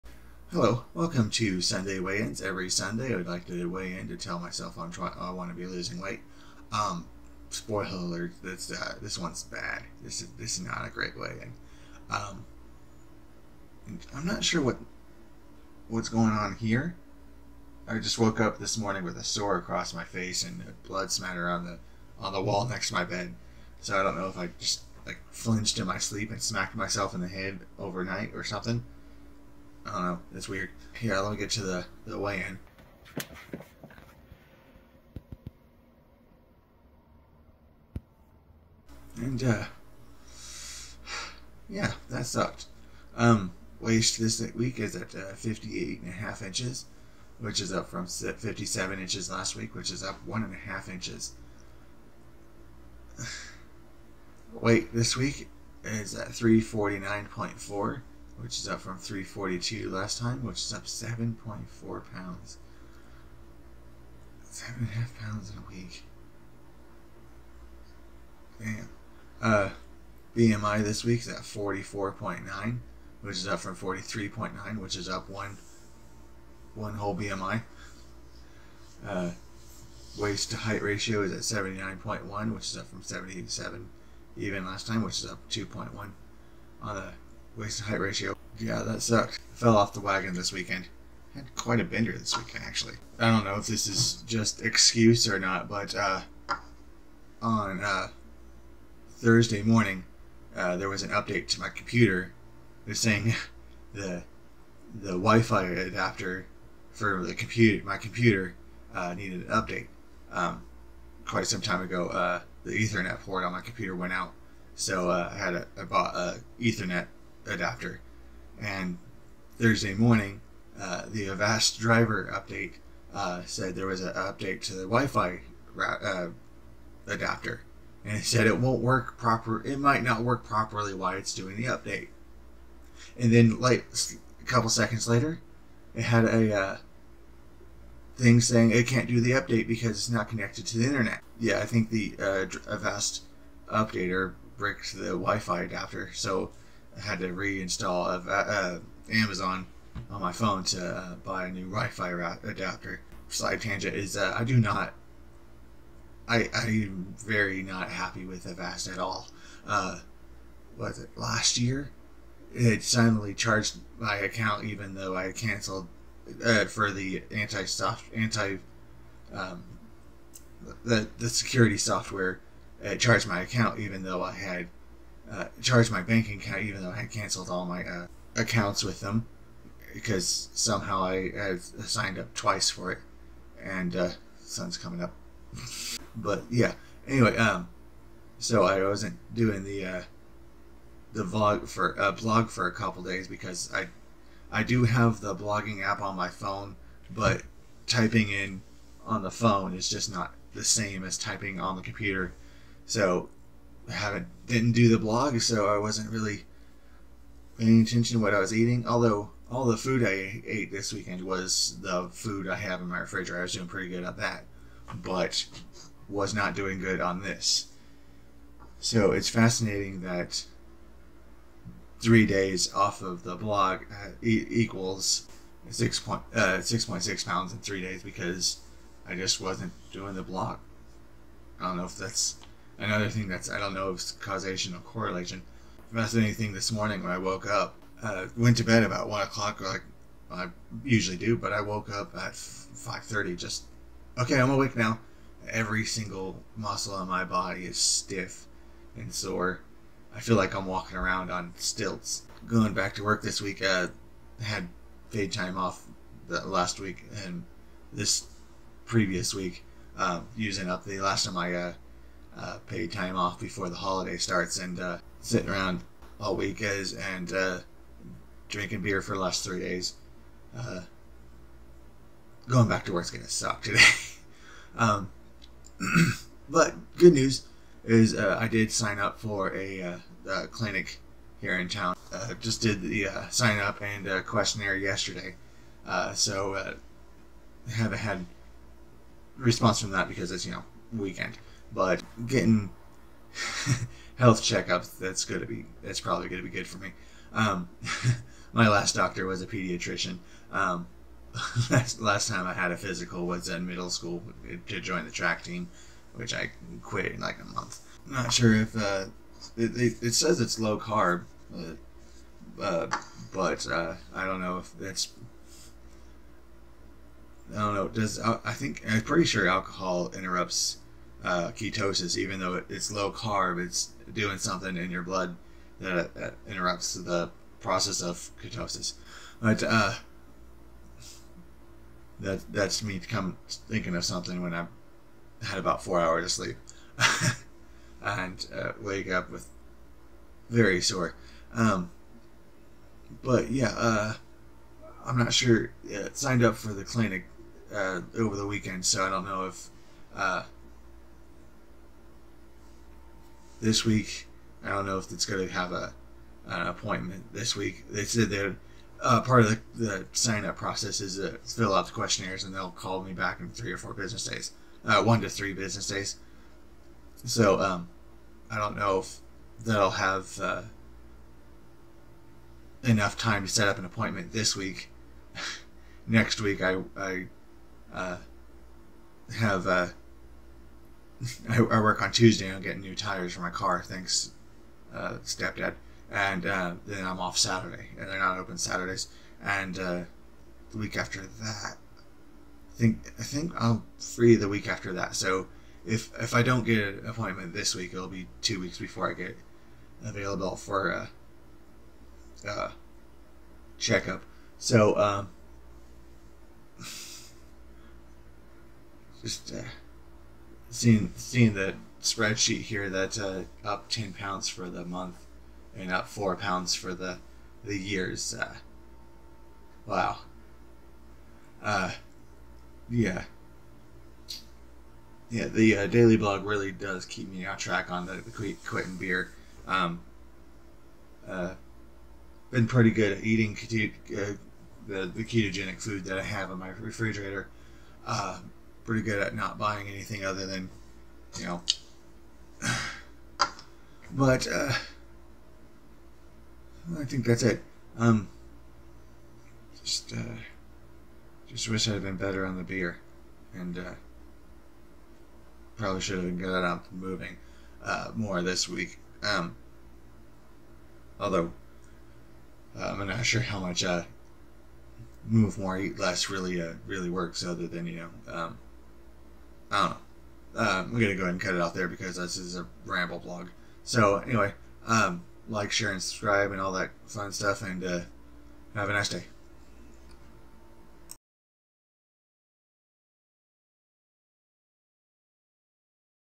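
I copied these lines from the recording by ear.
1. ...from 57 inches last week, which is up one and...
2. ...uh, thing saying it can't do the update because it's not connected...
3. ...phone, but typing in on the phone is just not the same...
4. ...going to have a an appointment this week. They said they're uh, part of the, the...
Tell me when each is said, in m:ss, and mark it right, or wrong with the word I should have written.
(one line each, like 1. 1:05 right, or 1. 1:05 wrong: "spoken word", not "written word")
1. 0:47 right
2. 2:16 right
3. 3:16 right
4. 5:55 right.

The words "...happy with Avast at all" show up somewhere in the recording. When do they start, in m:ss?
2:37.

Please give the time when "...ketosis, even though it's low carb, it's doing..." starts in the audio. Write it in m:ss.
5:21.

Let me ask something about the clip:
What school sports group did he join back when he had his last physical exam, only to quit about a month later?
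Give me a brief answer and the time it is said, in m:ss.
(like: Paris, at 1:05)
track team, at 5:05.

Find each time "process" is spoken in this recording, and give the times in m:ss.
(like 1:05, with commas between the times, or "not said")
5:27, 6:00.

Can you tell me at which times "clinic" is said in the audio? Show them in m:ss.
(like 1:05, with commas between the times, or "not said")
4:40, 5:46.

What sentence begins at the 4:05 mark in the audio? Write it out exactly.
Every single muscle in my body is stiff and sore.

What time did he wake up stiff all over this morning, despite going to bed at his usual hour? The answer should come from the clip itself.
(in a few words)
5:30.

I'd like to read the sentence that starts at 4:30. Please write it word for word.
Uh, going back to work is gonna suck today.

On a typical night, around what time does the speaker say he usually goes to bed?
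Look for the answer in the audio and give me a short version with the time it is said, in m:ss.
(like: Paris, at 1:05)
1 o'clock, at 3:59.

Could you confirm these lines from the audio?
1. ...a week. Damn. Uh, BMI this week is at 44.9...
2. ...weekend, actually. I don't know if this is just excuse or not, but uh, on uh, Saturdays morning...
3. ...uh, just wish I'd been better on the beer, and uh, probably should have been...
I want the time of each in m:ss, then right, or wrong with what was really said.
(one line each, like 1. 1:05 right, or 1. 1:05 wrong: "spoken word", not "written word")
1. 1:05 right
2. 1:32 wrong: "Thursday", not "Saturdays"
3. 7:30 right.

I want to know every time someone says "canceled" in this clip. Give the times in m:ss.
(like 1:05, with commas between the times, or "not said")
2:45, 2:57.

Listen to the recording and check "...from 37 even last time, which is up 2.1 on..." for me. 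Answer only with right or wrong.
wrong.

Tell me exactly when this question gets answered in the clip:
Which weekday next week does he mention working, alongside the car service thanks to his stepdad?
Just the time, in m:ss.
6:22.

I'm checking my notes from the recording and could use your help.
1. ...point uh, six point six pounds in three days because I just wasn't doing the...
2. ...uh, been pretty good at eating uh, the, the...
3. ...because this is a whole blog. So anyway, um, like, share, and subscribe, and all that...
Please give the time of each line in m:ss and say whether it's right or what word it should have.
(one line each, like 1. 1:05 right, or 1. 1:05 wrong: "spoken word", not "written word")
1. 3:45 right
2. 7:11 right
3. 7:51 wrong: "ramble", not "whole".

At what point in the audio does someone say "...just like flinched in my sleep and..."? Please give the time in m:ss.
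0:24.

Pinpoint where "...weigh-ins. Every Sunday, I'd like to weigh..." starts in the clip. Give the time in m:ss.
0:02.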